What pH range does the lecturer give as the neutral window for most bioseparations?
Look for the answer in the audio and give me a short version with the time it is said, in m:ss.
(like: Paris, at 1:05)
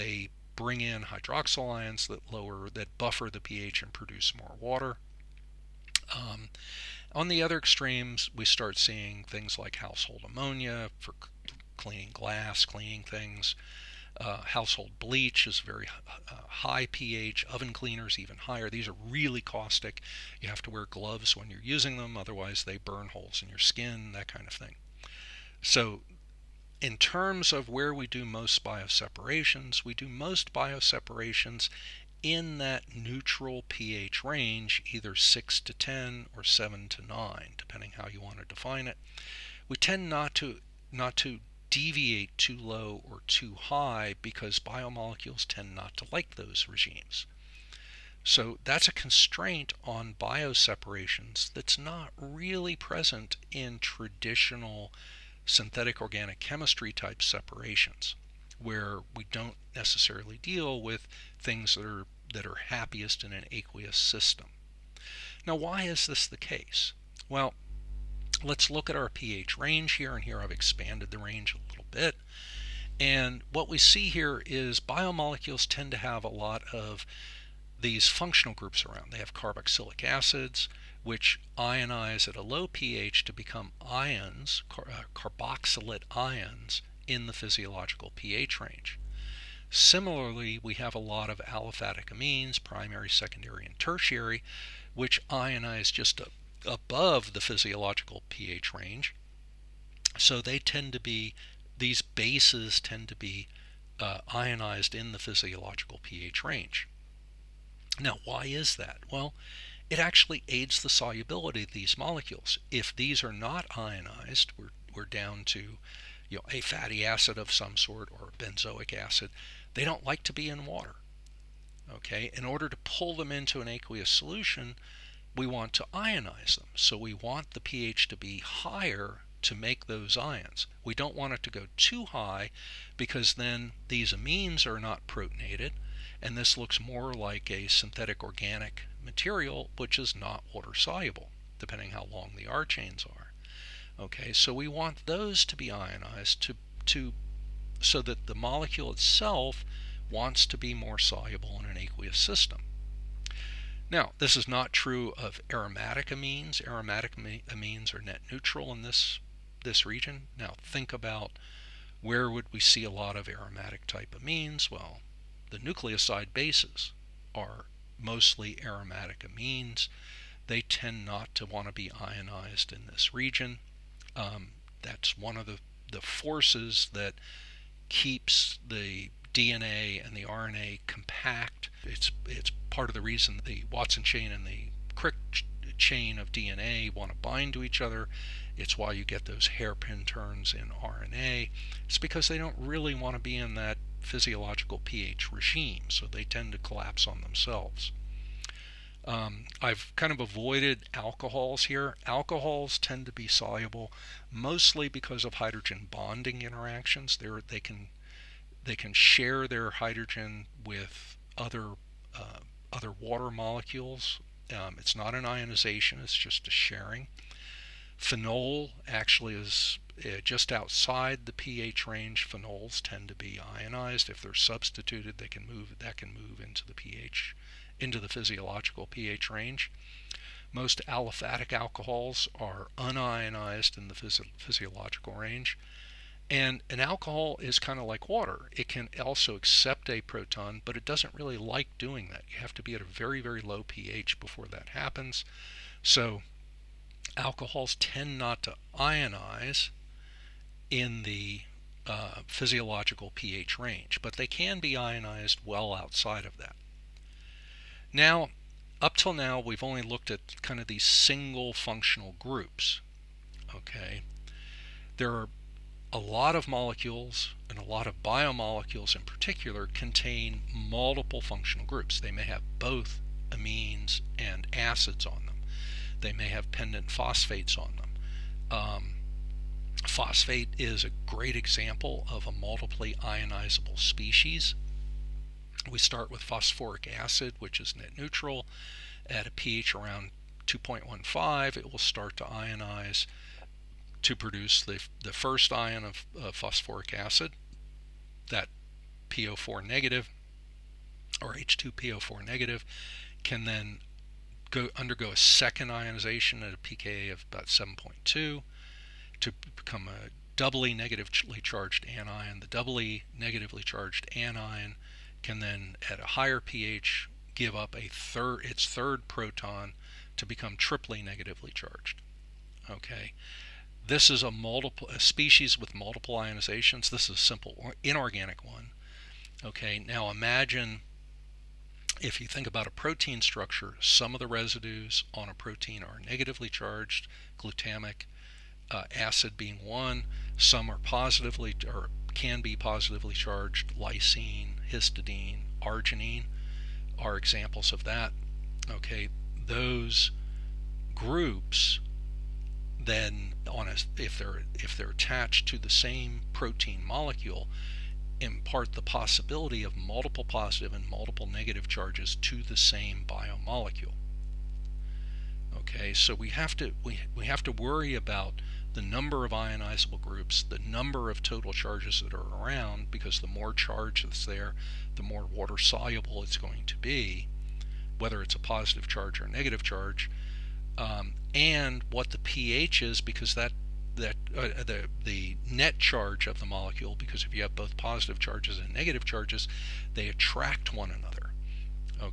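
6 to 10, at 0:35.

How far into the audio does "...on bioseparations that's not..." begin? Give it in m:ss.
0:49.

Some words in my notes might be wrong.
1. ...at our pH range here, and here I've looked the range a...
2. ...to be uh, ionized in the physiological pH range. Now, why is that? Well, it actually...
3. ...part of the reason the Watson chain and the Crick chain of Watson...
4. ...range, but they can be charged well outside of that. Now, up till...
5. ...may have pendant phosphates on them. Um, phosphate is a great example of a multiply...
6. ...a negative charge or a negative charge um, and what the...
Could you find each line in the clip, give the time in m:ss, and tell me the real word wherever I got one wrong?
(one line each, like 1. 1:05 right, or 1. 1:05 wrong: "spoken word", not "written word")
1. 1:08 wrong: "expanded", not "looked"
2. 1:43 right
3. 3:02 wrong: "DNA", not "Watson"
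4. 4:13 wrong: "ionized", not "charged"
5. 4:36 right
6. 6:18 wrong: "positive", not "negative".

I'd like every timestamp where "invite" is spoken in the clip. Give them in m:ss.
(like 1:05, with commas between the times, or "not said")
not said.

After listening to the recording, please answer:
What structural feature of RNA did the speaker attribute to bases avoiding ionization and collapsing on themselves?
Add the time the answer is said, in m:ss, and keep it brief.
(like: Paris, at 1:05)
hairpin turns, at 3:09.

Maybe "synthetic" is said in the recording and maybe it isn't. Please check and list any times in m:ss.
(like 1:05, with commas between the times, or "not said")
0:55, 2:17.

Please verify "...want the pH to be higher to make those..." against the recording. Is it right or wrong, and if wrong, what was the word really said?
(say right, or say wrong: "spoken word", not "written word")
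right.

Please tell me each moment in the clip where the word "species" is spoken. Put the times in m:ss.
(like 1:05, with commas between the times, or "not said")
4:43, 5:24.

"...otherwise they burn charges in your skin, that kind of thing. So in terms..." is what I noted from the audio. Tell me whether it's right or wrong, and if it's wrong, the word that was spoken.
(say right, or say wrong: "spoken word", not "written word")
wrong: "holes", not "charges".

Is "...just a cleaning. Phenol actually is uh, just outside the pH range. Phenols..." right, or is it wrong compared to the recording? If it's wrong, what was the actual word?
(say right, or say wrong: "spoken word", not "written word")
wrong: "sharing", not "cleaning".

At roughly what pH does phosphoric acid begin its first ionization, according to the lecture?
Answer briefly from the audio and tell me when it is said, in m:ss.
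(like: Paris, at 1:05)
2.15, at 4:50.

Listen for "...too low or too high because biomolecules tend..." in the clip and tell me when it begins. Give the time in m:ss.
0:42.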